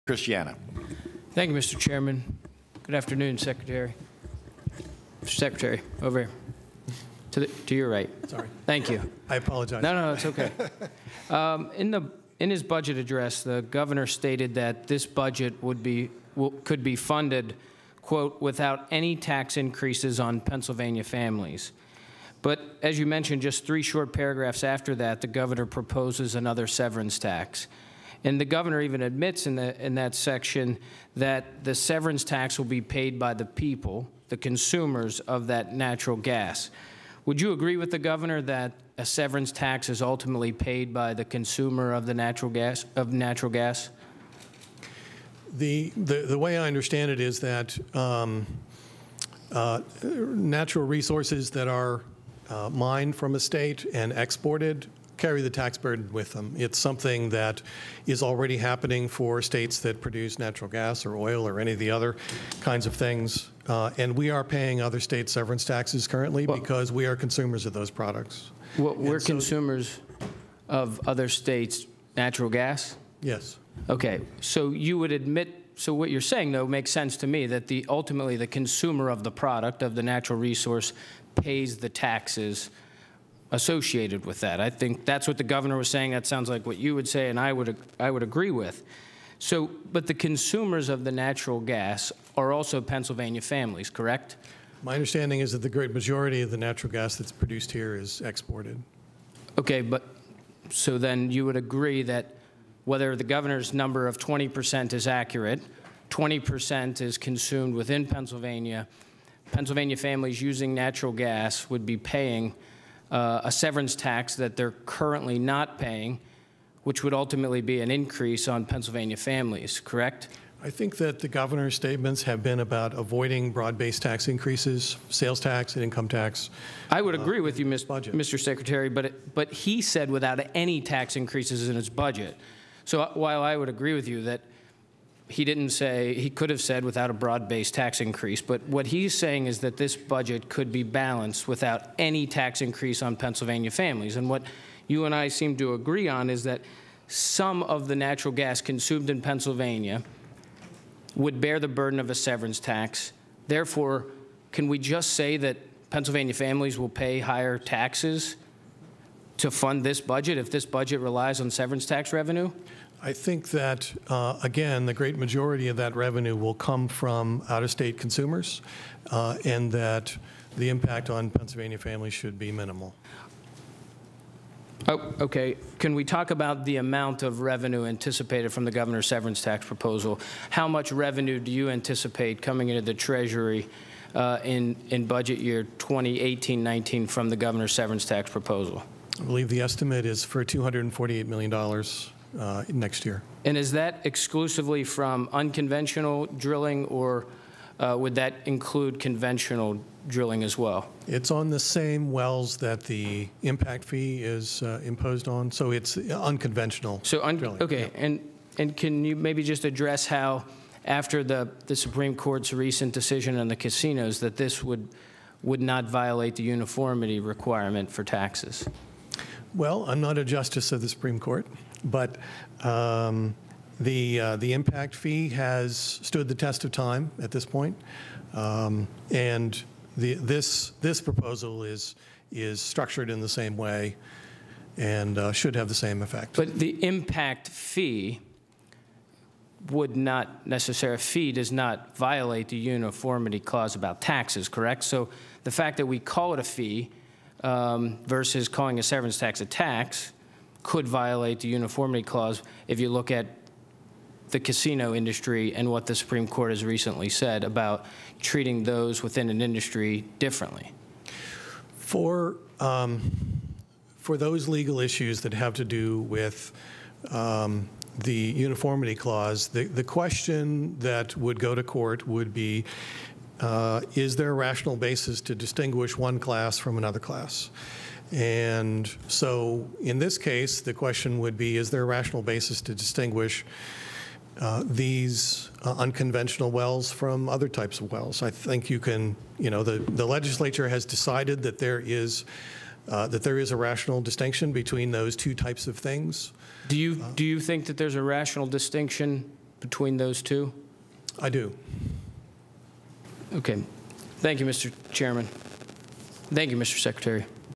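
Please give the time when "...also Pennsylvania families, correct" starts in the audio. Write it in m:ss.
1:32.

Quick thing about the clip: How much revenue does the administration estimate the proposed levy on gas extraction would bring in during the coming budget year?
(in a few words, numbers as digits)
$248 million.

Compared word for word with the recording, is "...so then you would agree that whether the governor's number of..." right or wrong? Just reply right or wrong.
right.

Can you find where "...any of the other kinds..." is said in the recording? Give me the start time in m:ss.
1:01.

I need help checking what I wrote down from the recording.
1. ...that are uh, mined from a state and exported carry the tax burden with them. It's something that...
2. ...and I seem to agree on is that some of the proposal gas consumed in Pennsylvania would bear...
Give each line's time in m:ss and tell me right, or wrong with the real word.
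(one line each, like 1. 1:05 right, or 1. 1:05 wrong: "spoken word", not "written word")
1. 0:51 right
2. 2:25 wrong: "natural", not "proposal".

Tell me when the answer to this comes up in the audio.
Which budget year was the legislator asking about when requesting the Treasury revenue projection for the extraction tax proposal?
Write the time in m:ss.
3:05.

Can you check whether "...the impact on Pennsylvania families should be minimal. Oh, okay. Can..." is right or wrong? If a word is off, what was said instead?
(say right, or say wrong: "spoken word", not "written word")
right.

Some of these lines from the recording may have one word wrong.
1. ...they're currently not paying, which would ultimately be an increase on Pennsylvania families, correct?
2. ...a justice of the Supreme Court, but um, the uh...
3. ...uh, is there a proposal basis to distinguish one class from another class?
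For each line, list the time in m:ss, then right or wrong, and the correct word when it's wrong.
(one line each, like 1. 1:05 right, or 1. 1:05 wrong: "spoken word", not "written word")
1. 1:54 right
2. 3:40 right
3. 4:33 wrong: "rational", not "proposal".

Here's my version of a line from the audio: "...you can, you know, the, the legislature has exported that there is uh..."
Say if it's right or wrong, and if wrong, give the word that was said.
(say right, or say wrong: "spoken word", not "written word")
wrong: "decided", not "exported".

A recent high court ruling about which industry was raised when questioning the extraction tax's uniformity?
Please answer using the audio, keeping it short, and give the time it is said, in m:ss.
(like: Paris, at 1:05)
Casinos, at 3:33.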